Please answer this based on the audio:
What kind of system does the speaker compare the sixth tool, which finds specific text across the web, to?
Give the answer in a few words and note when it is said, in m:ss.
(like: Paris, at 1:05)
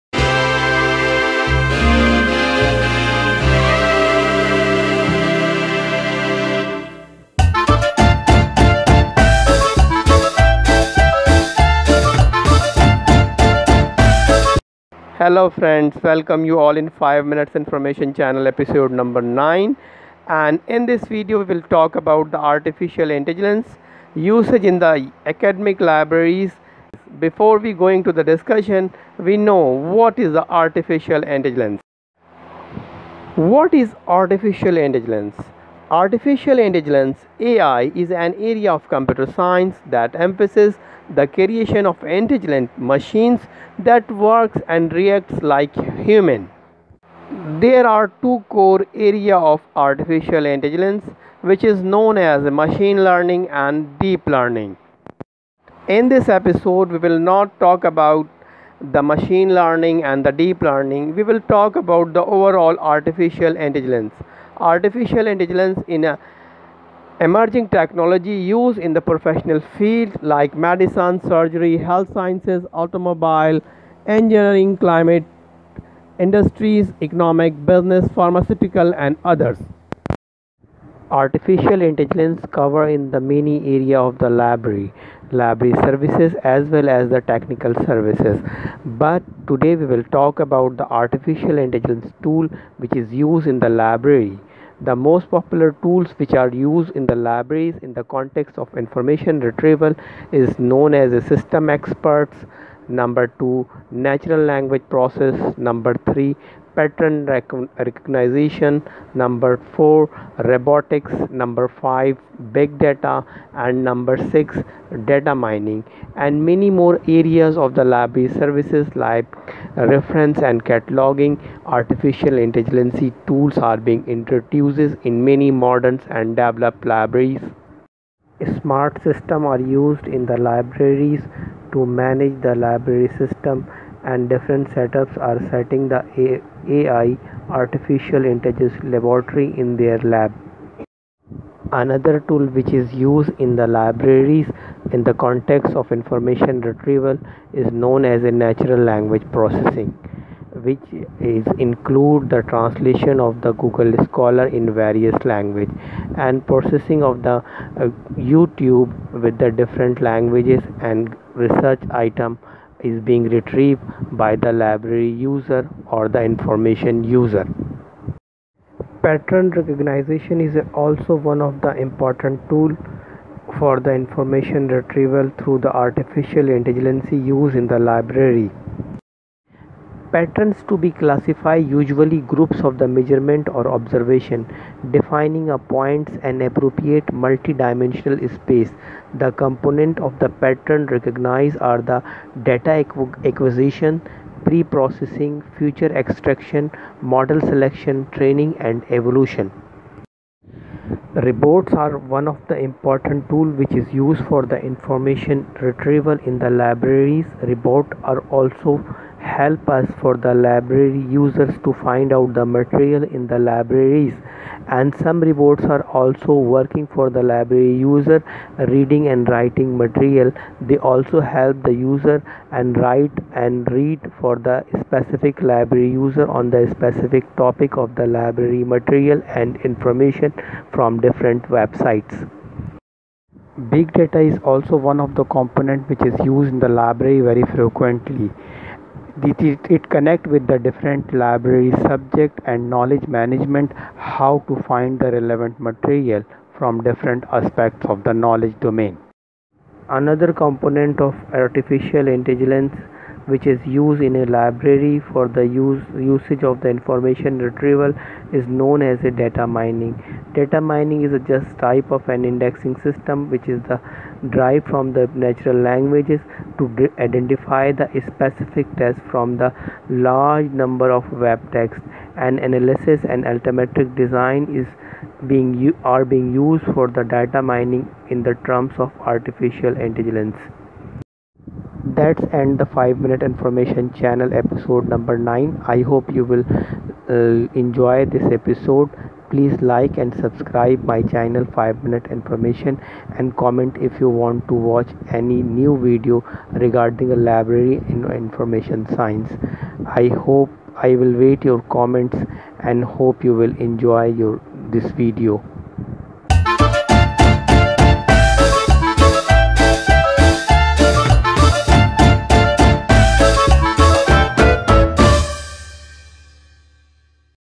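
indexing system, at 4:22.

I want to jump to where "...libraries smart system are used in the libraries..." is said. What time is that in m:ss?
2:06.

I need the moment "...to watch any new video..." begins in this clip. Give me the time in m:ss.
4:54.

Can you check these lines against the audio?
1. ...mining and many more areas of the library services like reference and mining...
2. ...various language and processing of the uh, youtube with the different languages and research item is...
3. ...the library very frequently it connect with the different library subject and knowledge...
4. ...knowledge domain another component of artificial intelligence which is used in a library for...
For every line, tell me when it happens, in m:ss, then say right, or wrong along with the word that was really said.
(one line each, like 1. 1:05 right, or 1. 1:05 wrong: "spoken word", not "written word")
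1. 1:55 wrong: "cataloging", not "mining"
2. 2:34 right
3. 3:56 right
4. 4:08 right.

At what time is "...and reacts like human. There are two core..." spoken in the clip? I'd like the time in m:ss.
0:44.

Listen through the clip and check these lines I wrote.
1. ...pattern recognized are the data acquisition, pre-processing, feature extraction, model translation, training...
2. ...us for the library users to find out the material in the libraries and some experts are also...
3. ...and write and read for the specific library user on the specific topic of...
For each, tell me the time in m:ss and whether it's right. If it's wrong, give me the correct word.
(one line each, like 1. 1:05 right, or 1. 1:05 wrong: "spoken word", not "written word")
1. 3:10 wrong: "selection", not "translation"
2. 3:29 wrong: "reports", not "experts"
3. 3:42 right.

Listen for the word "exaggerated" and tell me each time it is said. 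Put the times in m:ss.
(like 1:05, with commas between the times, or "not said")
not said.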